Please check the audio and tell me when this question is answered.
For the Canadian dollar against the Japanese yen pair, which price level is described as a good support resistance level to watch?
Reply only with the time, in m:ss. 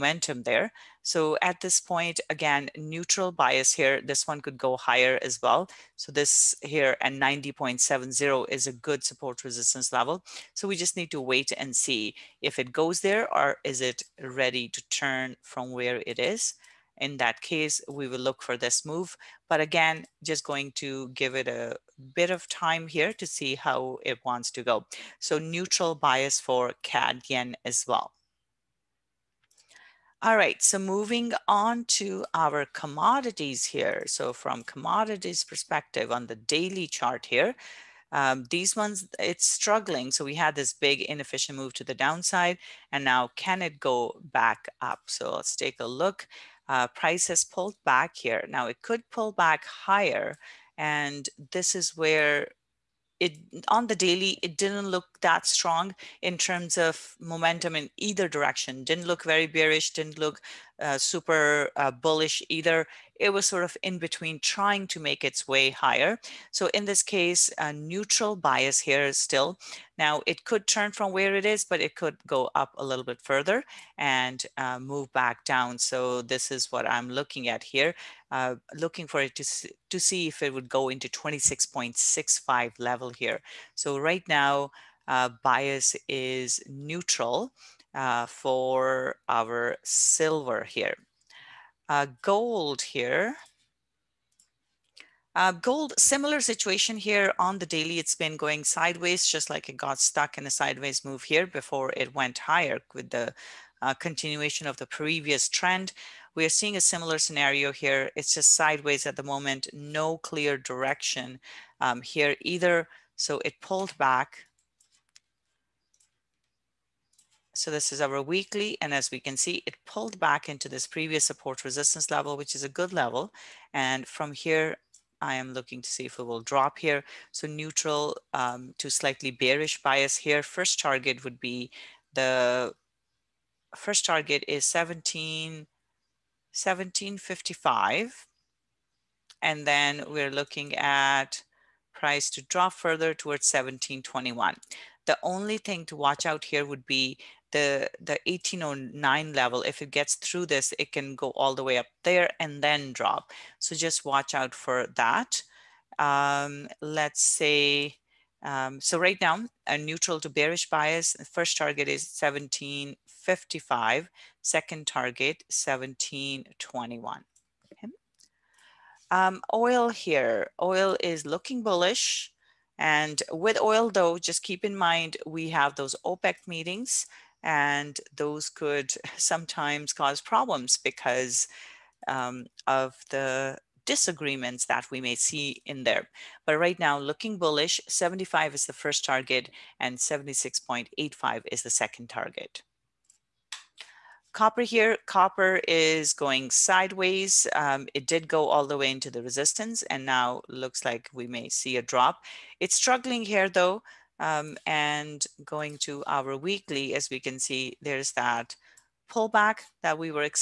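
0:07.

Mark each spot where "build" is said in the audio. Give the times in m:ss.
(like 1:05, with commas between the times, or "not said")
not said.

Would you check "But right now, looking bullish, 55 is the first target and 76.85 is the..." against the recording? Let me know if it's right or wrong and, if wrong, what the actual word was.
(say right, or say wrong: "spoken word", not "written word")
wrong: "75", not "55".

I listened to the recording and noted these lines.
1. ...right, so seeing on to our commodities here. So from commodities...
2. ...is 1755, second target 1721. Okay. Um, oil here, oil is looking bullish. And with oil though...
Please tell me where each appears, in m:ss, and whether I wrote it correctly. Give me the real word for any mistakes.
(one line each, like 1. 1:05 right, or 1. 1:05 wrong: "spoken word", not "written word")
1. 0:30 wrong: "moving", not "seeing"
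2. 2:41 right.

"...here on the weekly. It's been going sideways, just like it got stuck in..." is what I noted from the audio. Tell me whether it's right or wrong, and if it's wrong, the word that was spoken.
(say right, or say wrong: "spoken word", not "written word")
wrong: "daily", not "weekly".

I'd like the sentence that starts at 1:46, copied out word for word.
We are seeing a similar scenario here.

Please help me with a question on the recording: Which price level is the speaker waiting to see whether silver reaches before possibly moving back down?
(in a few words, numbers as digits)
26.65.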